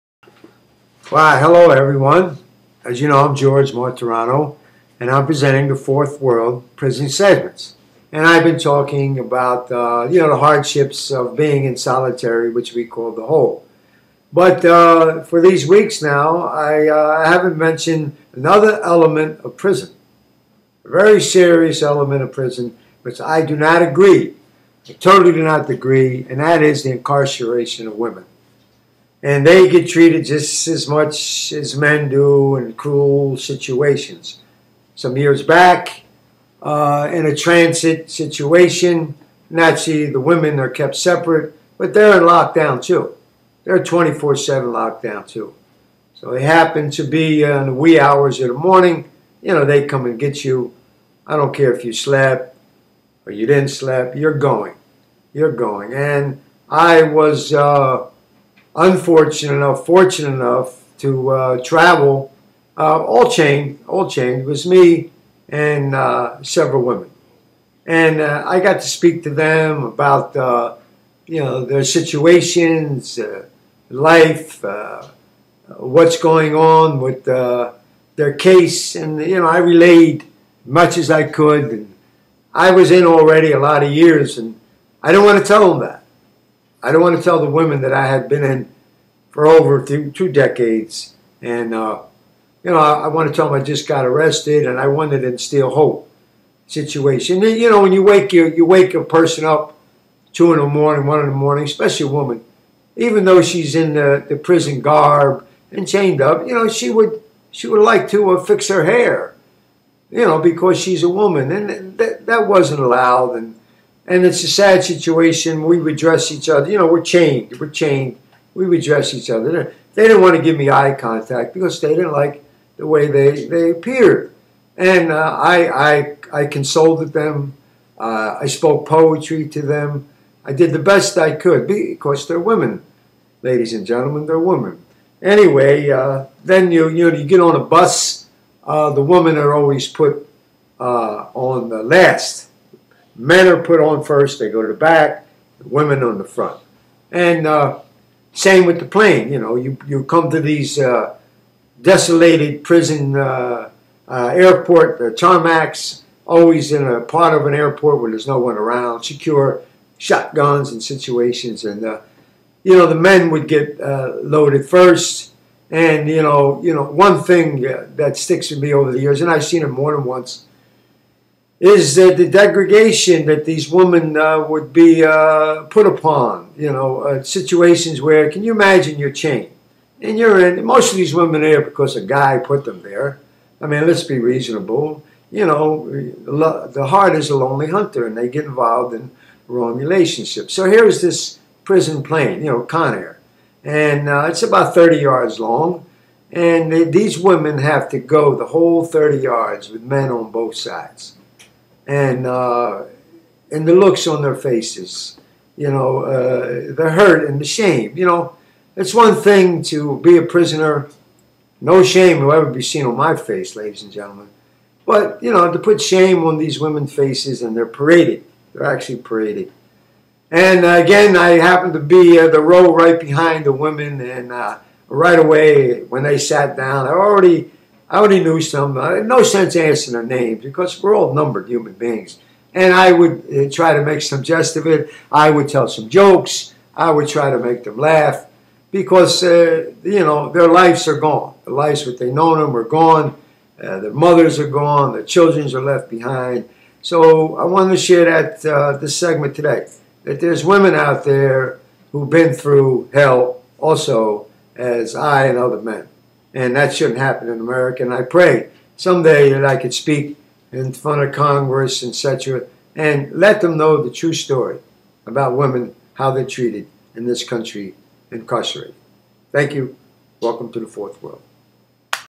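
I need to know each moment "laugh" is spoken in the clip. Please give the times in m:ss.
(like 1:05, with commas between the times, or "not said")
3:57.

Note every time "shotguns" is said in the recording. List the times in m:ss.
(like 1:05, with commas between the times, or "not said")
2:39.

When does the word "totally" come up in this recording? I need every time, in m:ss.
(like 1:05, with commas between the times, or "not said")
0:24.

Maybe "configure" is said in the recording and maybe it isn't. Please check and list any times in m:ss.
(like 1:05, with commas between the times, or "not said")
not said.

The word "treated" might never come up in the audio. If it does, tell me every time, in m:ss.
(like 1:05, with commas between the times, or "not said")
0:29, 4:26.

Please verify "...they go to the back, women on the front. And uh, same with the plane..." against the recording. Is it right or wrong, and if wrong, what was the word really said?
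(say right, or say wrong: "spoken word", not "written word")
right.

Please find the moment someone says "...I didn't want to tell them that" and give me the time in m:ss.
1:25.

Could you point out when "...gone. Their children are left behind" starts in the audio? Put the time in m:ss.
4:04.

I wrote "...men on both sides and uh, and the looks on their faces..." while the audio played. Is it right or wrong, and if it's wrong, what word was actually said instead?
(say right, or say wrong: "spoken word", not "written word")
right.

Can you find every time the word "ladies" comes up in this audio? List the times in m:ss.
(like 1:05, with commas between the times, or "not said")
2:13, 3:33.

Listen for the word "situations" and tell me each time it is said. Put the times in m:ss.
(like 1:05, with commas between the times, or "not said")
0:33, 0:38, 1:11, 1:36, 1:54, 2:40, 2:57.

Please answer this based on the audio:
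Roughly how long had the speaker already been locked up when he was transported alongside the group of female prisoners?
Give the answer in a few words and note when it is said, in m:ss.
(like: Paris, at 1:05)
over 2 decades, at 1:30.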